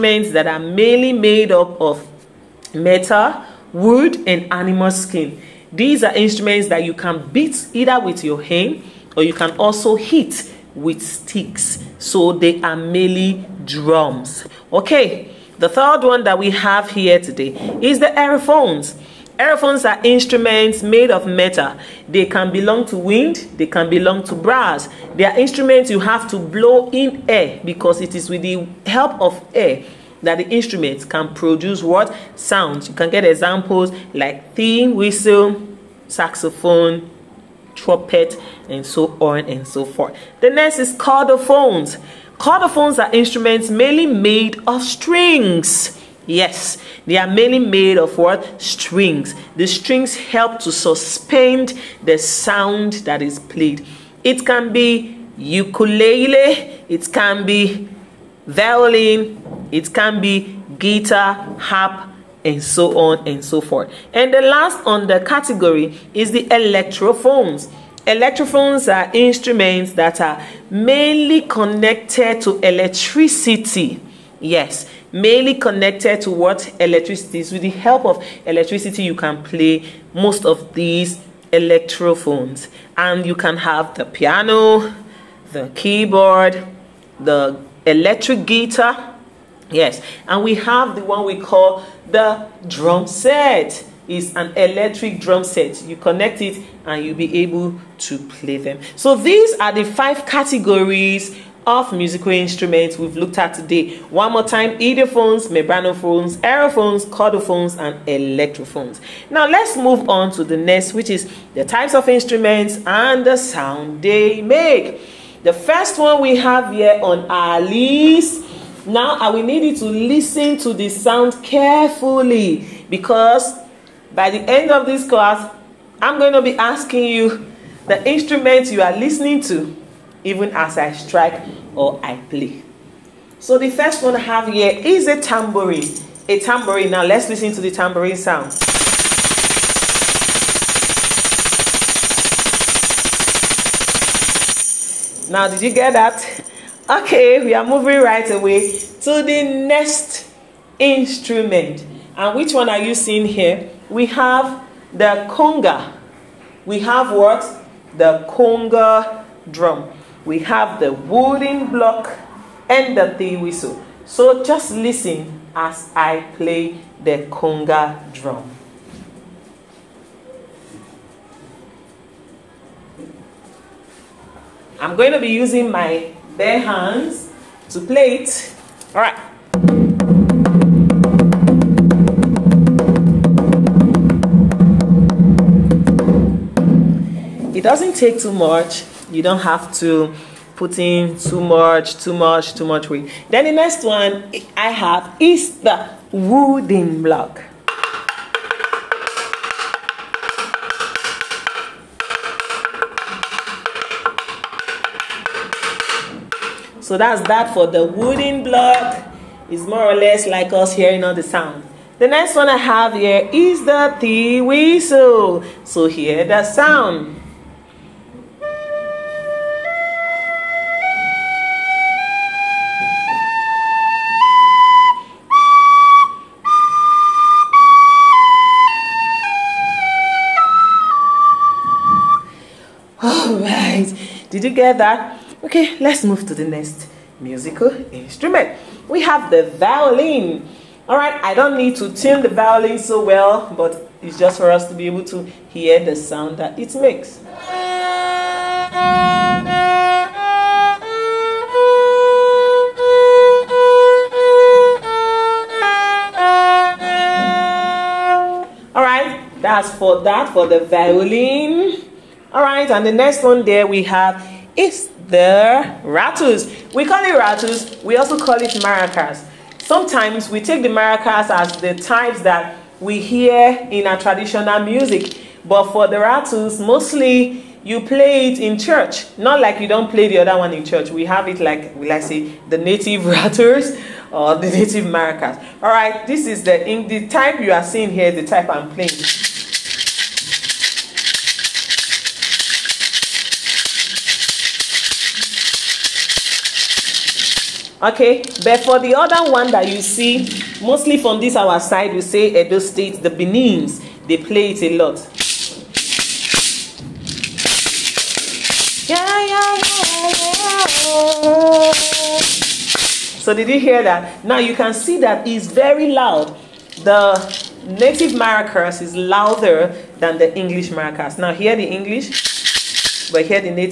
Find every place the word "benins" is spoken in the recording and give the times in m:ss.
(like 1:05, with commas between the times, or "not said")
5:03.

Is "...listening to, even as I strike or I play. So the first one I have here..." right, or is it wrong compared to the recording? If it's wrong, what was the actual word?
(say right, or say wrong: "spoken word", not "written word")
right.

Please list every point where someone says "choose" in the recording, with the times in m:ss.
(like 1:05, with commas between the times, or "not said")
not said.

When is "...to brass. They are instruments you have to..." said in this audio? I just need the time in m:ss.
0:24.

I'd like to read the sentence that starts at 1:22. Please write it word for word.
And you can have the piano, the keyboard, the electric guitar.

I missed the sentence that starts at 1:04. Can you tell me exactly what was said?
And the last on the category is the electrophones.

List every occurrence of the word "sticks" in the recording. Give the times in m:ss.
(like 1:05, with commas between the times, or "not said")
0:11.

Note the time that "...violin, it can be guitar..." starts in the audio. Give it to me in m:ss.
0:58.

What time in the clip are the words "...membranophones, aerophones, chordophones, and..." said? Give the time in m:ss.
1:45.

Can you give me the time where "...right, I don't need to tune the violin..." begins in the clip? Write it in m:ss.
4:00.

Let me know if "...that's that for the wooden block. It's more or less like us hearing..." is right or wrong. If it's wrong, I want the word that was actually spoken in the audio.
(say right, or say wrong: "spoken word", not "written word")
right.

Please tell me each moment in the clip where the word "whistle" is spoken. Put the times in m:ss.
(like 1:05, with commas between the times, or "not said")
0:34, 2:43, 3:34.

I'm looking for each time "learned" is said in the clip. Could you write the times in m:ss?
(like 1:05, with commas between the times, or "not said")
not said.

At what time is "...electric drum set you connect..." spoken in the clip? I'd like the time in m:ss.
1:34.